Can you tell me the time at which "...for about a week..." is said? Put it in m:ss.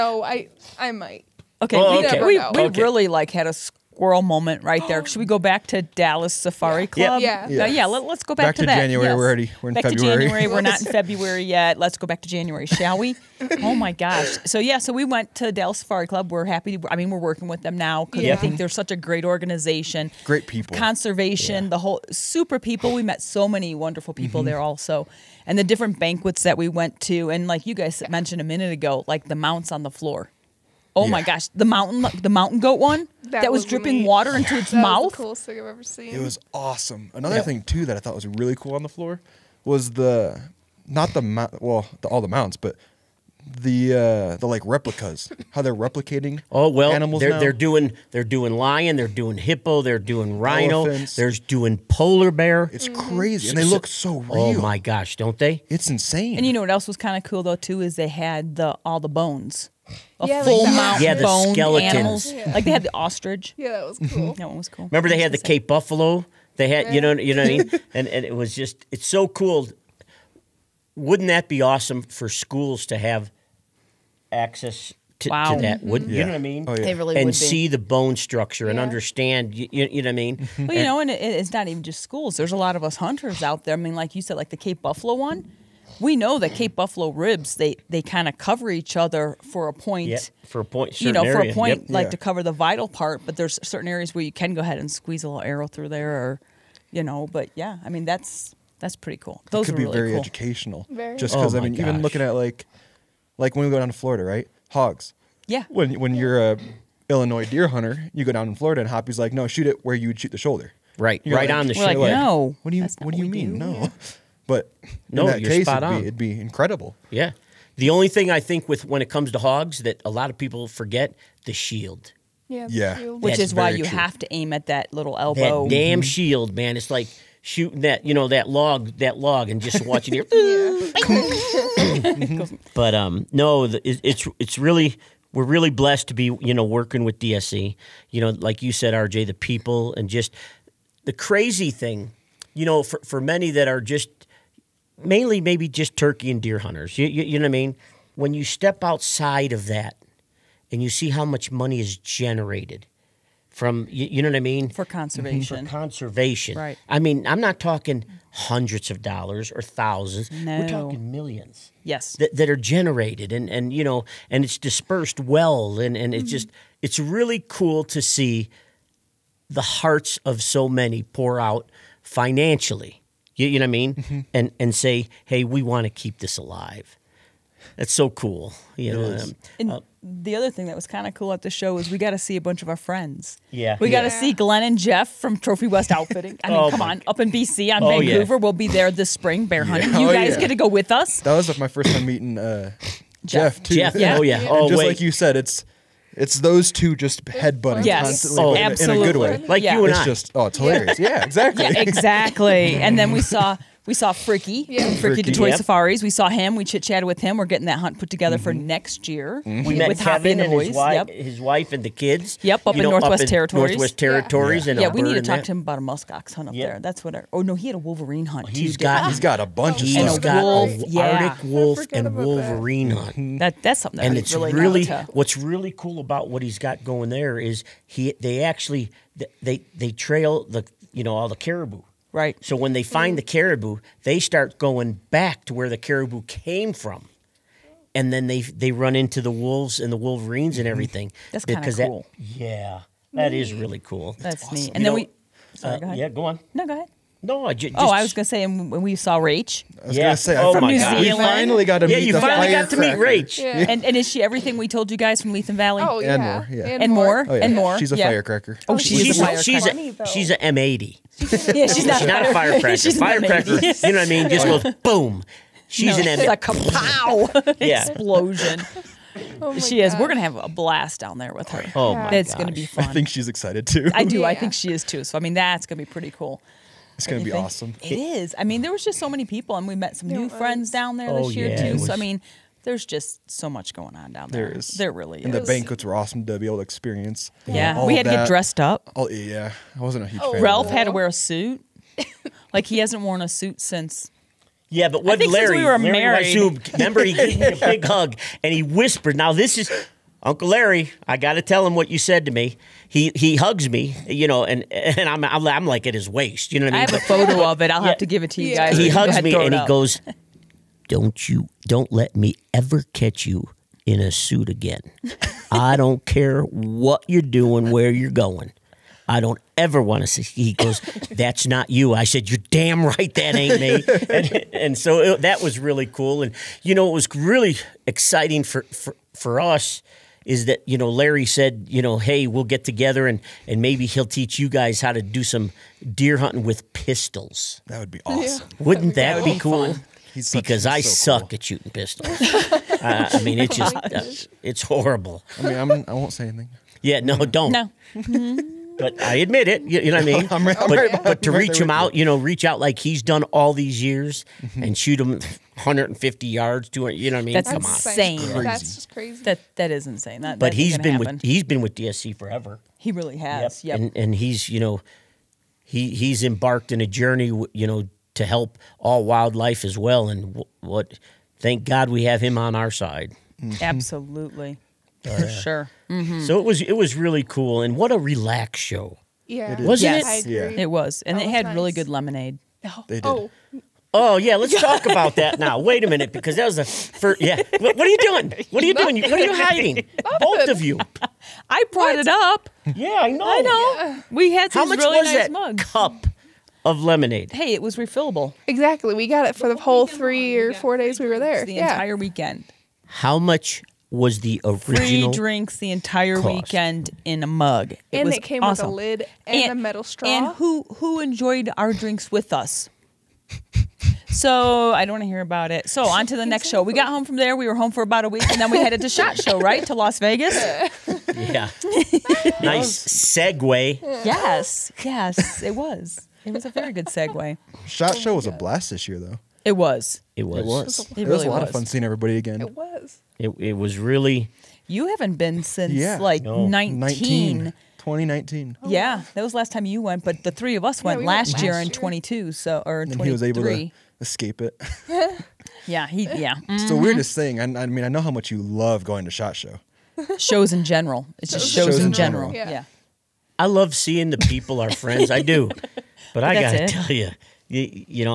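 6:57.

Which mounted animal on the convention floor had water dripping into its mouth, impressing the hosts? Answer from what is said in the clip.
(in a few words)
Mountain goat.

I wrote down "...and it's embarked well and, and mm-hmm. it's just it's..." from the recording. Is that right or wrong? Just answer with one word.
wrong.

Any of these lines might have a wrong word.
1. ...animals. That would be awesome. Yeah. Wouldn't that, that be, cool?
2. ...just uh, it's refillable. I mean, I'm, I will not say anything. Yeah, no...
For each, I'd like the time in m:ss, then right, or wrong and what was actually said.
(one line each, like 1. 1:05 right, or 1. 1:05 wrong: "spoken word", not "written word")
1. 5:36 wrong: "pistols", not "animals"
2. 5:43 wrong: "horrible", not "refillable".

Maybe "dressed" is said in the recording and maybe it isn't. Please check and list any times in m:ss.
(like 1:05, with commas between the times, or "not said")
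4:48.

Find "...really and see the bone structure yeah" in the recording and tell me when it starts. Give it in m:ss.
1:16.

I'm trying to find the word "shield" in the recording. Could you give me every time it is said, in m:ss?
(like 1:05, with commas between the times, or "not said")
2:01, 2:06.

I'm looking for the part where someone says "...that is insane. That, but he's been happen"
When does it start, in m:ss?
5:59.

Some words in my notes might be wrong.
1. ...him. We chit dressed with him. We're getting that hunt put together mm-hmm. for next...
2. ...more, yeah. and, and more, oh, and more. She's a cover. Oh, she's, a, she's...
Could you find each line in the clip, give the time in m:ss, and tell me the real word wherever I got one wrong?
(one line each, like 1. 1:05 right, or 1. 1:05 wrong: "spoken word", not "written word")
1. 3:26 wrong: "chatted", not "dressed"
2. 4:16 wrong: "firecracker", not "cover".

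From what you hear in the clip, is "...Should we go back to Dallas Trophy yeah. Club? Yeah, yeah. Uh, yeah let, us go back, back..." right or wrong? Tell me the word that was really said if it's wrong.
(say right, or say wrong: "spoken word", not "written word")
wrong: "Safari", not "Trophy".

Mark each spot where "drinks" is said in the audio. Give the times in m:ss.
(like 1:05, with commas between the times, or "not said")
6:45, 6:51.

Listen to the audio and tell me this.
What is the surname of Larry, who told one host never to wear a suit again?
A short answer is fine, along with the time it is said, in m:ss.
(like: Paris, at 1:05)
Weishuhn, at 4:56.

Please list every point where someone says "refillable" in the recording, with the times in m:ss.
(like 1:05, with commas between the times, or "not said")
6:37.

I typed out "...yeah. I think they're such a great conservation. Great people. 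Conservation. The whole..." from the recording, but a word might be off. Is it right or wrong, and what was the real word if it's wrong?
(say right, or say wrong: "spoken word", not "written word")
wrong: "organization", not "conservation".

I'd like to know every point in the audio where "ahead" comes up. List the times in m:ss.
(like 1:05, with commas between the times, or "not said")
1:34, 4:06.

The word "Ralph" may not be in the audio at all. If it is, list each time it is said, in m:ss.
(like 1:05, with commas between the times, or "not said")
4:50.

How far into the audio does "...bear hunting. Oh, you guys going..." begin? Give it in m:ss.
3:09.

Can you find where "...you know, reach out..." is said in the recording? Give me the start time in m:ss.
5:51.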